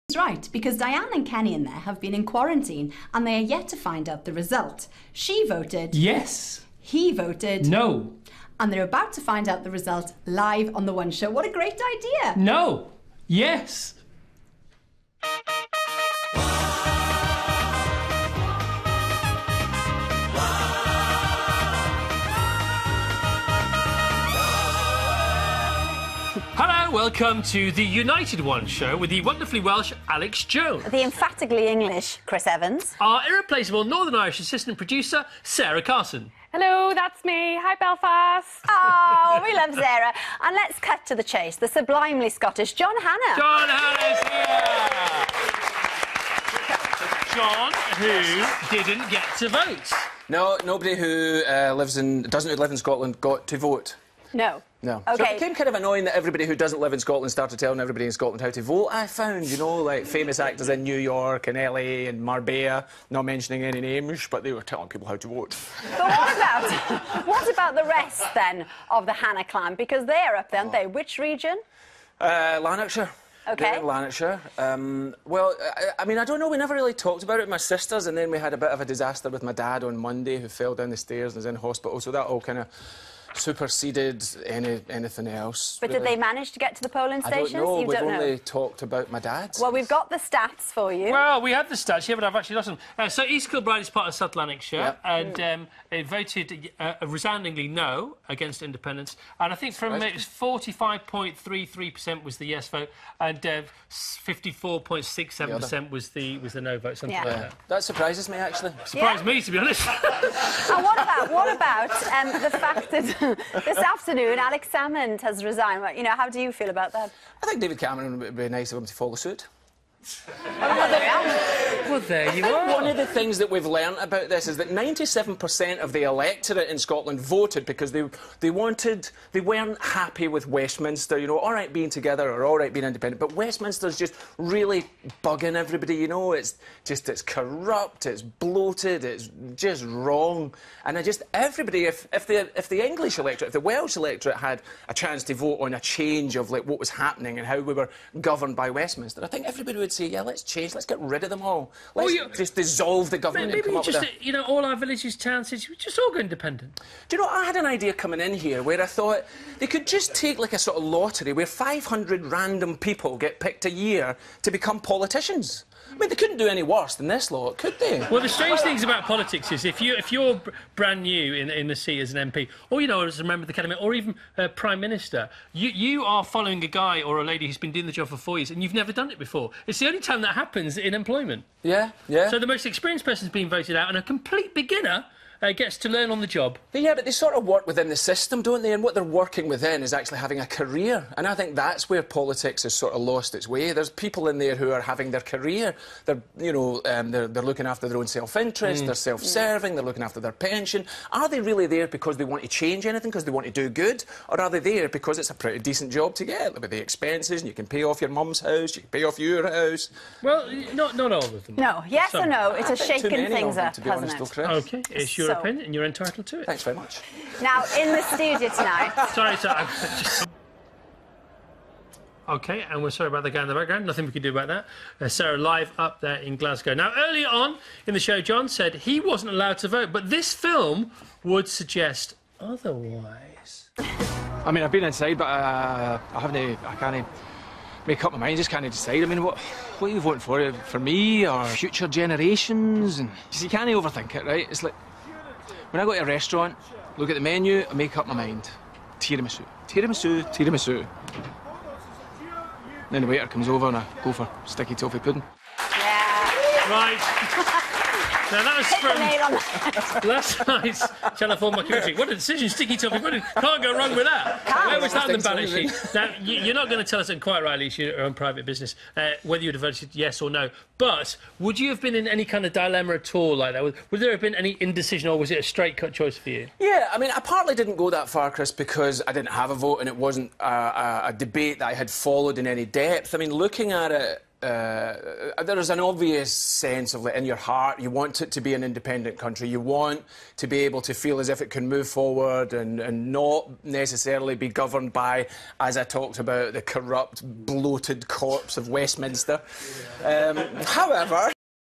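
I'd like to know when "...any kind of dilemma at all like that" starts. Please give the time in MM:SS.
04:32.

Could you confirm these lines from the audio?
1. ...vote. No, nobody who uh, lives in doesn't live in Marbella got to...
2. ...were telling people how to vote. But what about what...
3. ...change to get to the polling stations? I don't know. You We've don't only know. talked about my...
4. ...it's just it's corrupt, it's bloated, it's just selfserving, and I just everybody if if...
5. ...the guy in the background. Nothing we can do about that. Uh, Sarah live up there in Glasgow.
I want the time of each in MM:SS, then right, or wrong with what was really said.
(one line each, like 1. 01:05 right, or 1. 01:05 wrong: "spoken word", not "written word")
1. 00:49 wrong: "Scotland", not "Marbella"
2. 01:04 right
3. 01:26 wrong: "manage", not "change"
4. 02:16 wrong: "wrong", not "selfserving"
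5. 03:43 right.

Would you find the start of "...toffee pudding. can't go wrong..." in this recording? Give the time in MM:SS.
04:22.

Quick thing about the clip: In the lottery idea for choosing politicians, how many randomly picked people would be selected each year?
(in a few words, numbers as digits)
500.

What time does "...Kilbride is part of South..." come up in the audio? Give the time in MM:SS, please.
01:33.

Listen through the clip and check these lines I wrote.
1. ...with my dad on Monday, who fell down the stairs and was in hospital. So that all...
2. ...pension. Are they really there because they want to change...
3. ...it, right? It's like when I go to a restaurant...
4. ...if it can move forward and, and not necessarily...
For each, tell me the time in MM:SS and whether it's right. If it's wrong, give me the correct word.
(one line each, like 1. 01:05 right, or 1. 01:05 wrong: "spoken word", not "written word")
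1. 01:19 right
2. 03:20 right
3. 04:04 right
4. 04:51 right.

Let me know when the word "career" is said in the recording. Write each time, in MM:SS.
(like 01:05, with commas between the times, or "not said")
03:10, 03:15.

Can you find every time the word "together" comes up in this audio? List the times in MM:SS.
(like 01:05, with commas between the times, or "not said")
02:11.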